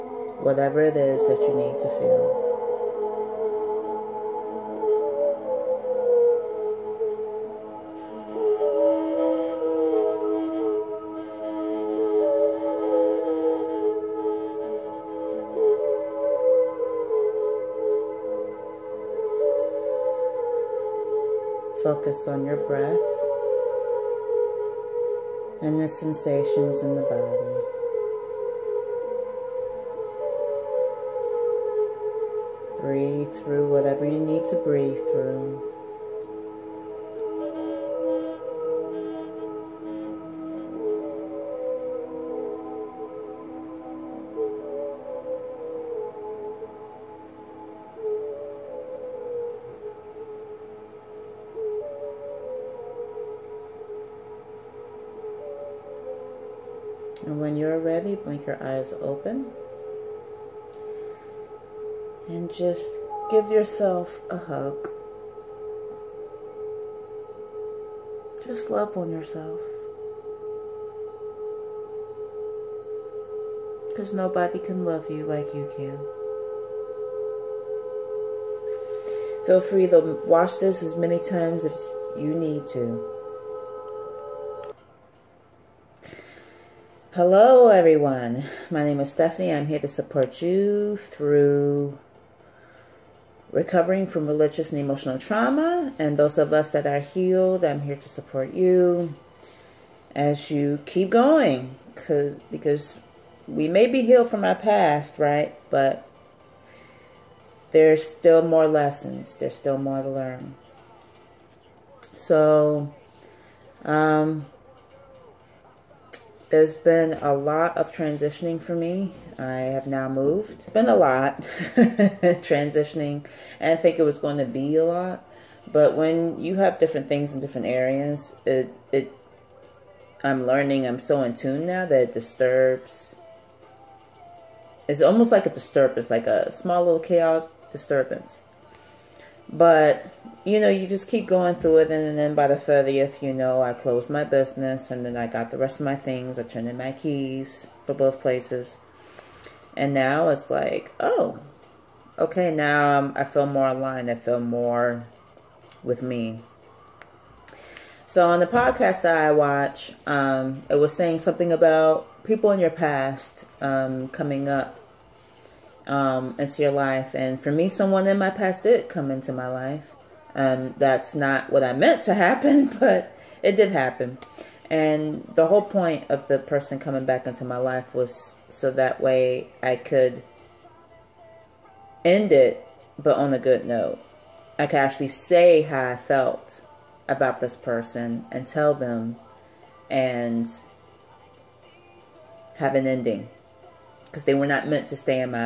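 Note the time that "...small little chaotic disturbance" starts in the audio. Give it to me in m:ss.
2:16.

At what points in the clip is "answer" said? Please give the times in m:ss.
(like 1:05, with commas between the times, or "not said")
not said.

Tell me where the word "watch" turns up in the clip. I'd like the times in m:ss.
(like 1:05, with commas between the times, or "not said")
1:20, 2:39.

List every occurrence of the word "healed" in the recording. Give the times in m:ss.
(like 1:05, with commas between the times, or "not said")
1:37, 1:44.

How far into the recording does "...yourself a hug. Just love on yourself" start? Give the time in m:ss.
1:03.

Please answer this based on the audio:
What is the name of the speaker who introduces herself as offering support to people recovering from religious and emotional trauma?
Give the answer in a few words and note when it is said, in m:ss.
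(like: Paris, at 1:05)
Stephanie, at 1:29.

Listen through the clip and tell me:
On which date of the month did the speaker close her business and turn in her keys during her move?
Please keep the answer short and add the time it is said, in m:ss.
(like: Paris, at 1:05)
30th, at 2:22.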